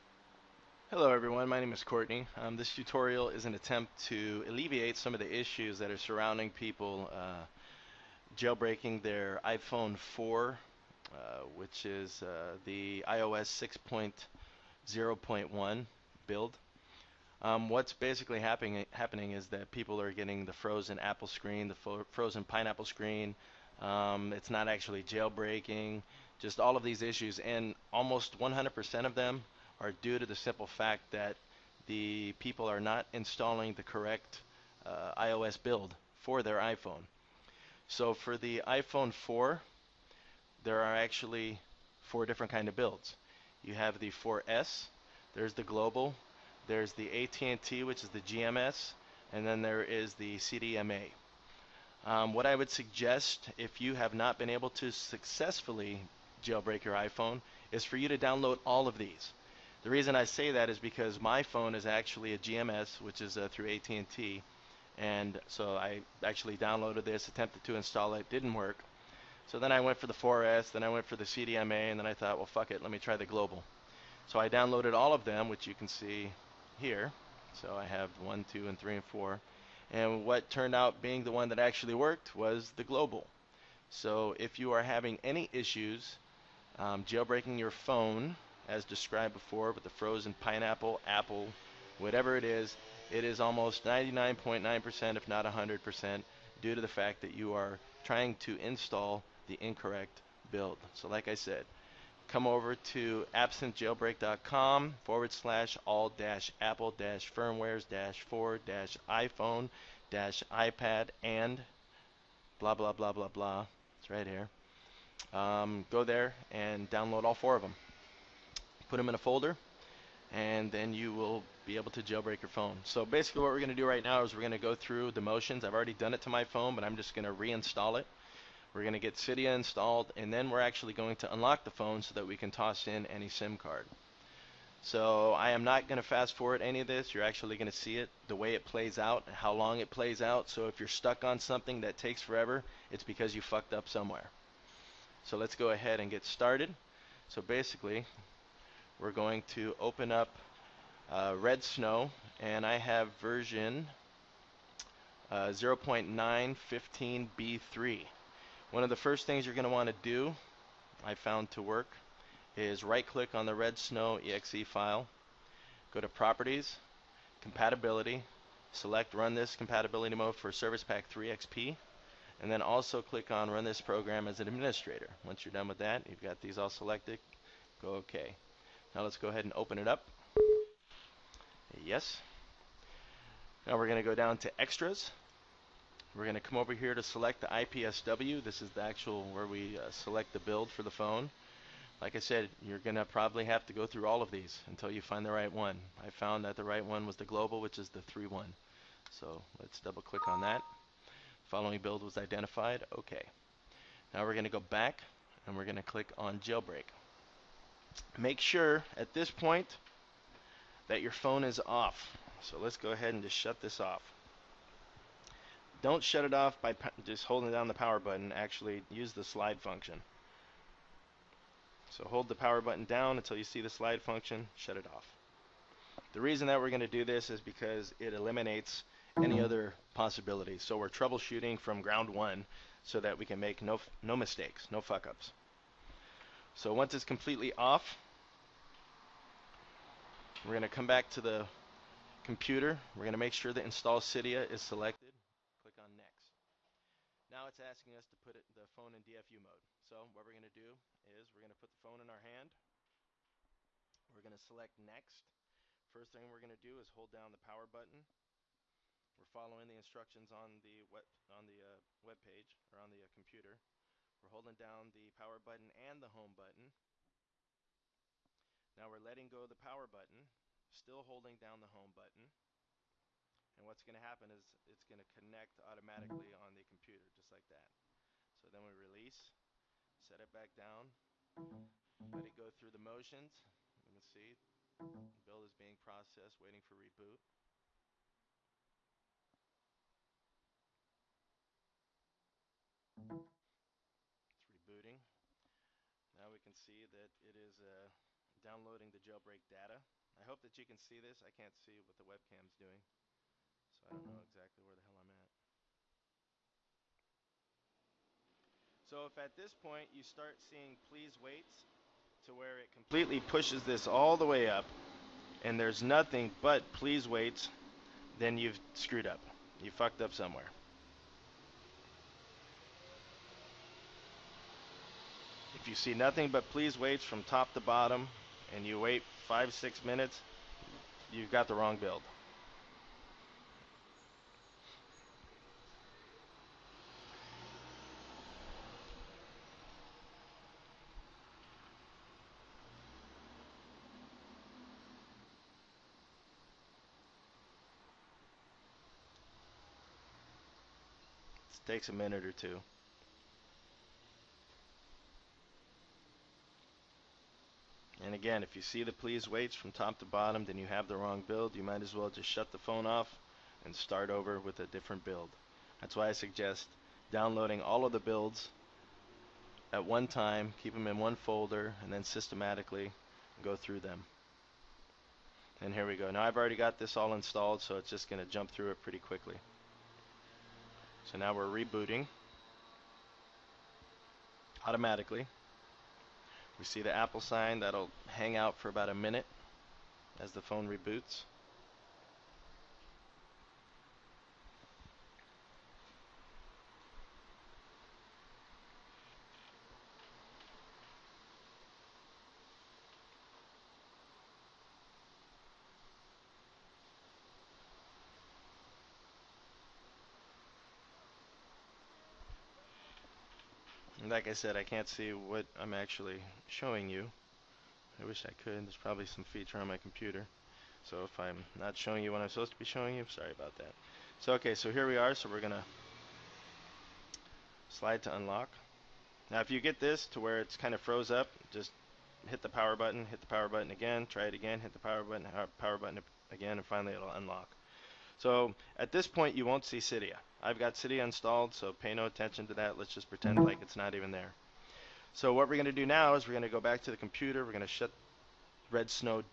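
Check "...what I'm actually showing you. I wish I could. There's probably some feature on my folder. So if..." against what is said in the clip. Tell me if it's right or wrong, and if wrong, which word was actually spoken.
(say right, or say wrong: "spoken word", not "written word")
wrong: "computer", not "folder".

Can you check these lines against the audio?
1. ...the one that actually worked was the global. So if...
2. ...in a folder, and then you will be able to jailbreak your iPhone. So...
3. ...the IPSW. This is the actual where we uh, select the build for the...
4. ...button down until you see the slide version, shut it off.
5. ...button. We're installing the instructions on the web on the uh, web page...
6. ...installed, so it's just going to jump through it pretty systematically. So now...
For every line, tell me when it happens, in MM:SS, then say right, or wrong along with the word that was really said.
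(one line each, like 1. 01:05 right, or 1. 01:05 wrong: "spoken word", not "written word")
1. 01:21 right
2. 01:59 wrong: "phone", not "iPhone"
3. 03:07 right
4. 03:42 wrong: "function", not "version"
5. 04:17 wrong: "following", not "installing"
6. 06:17 wrong: "quickly", not "systematically".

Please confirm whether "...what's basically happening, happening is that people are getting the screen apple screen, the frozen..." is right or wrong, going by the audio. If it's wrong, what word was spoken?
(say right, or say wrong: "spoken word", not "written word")
wrong: "frozen", not "screen".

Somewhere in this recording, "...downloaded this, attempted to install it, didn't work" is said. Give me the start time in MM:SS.
01:06.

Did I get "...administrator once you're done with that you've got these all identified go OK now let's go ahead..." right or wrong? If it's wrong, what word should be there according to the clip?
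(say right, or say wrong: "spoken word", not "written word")
wrong: "selected", not "identified".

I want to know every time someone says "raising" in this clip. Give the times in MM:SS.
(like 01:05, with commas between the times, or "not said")
not said.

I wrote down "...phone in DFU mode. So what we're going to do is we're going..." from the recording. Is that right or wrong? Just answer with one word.
right.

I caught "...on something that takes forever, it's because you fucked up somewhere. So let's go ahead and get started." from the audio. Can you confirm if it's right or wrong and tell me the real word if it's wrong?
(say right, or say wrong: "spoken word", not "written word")
right.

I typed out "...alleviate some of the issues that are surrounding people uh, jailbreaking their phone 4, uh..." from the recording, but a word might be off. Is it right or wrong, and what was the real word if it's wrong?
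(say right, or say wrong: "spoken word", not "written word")
wrong: "iPhone", not "phone".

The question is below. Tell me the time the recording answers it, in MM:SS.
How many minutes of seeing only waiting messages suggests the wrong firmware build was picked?
05:29.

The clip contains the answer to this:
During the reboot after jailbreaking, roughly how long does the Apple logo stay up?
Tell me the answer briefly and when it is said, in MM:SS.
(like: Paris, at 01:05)
about a minute, at 06:28.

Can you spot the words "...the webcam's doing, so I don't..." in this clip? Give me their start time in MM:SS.
05:01.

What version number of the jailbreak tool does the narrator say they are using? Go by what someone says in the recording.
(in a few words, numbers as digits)
0.915b3.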